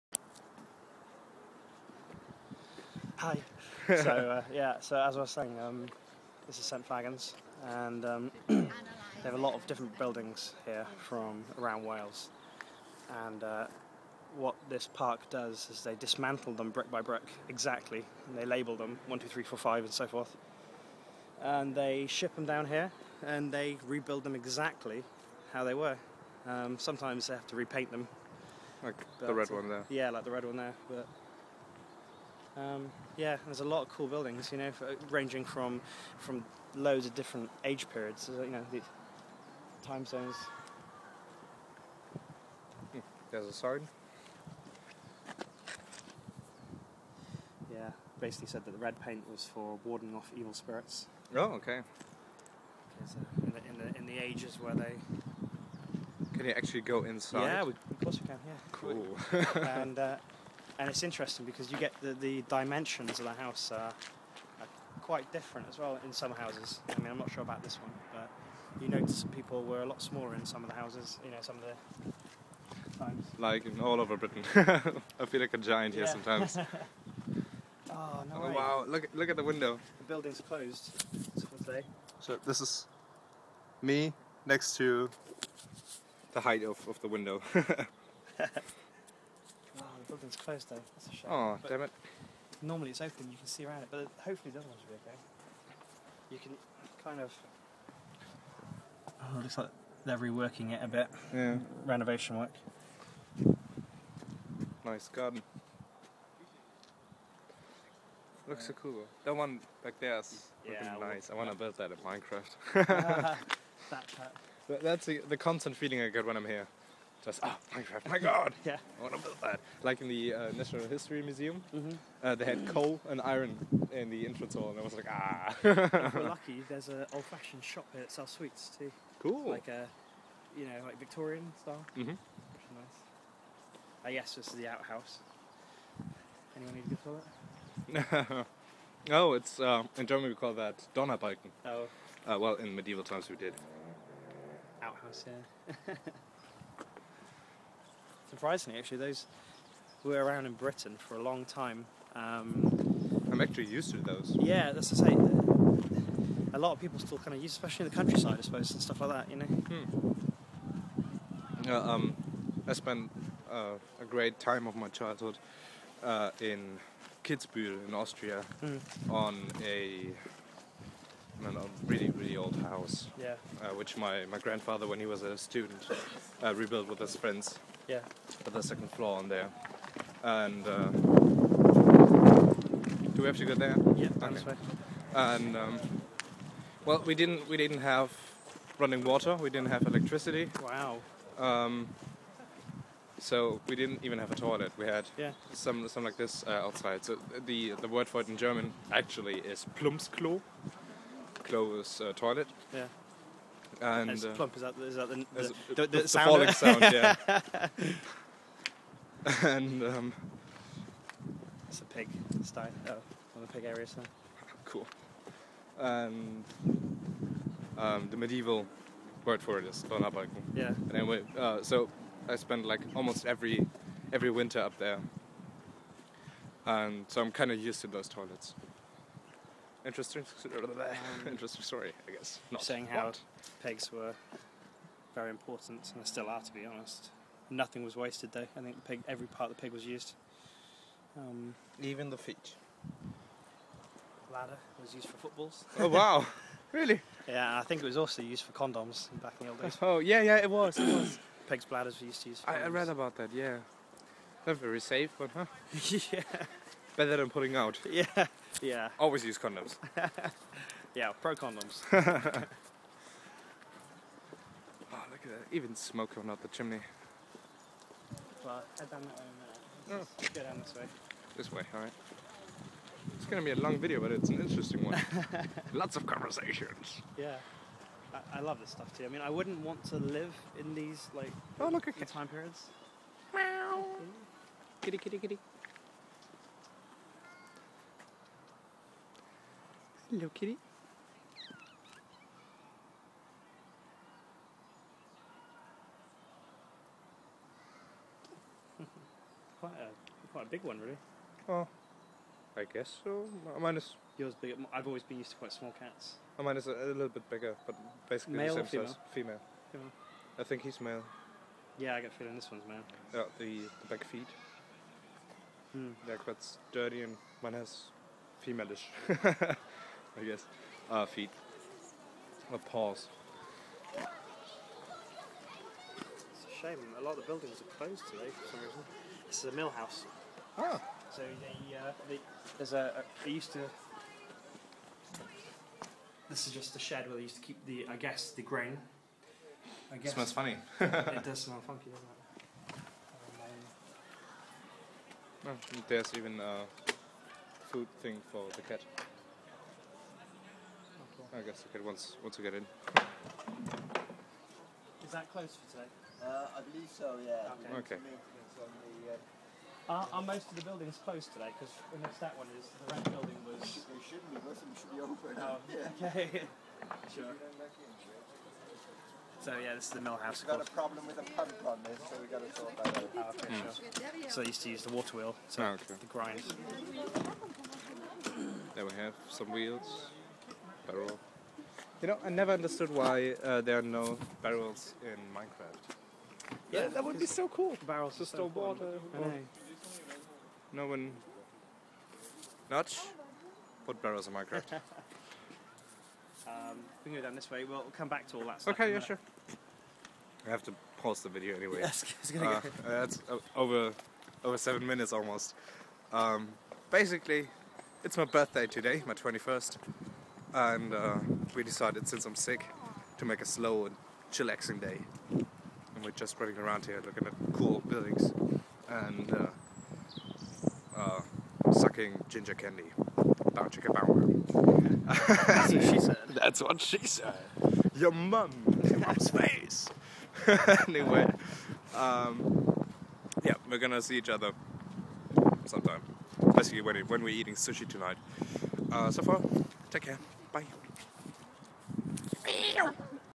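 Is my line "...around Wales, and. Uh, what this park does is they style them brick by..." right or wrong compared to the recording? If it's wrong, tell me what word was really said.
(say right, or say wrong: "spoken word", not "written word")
wrong: "dismantle", not "style".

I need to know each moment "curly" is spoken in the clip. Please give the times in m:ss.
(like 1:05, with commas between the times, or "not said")
not said.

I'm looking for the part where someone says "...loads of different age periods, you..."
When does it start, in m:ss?
0:36.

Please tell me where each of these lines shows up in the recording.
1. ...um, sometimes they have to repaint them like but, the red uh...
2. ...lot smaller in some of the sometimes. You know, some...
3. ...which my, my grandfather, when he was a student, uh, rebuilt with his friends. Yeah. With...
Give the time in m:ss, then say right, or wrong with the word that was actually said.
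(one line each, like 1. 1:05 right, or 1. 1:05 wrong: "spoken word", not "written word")
1. 0:26 right
2. 1:09 wrong: "houses", not "sometimes"
3. 2:53 right.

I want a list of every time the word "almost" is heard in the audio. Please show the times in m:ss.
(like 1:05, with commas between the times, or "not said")
3:42, 6:45.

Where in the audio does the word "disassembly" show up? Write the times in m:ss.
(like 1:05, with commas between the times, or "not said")
not said.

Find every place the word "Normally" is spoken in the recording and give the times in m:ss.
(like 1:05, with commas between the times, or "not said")
1:32.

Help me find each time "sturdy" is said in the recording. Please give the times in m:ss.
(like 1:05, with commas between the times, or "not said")
5:16.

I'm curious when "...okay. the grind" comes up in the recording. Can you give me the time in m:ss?
6:15.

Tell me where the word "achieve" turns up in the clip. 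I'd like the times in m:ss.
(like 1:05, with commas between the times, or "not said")
not said.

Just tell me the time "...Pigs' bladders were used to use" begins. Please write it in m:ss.
4:11.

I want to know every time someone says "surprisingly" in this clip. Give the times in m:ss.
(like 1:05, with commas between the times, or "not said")
2:28.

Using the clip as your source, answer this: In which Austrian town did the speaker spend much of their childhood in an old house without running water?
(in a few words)
Kitzbühel.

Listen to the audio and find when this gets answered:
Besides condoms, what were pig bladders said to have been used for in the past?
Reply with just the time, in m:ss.
4:05.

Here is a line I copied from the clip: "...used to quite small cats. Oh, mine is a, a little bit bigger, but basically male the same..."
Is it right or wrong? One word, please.
right.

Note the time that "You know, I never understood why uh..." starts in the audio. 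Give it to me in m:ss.
6:22.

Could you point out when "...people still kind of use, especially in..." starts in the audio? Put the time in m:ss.
2:36.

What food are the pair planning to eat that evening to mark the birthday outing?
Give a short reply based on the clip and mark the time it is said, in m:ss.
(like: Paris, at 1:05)
sushi, at 7:17.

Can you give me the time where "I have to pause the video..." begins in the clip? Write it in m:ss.
6:40.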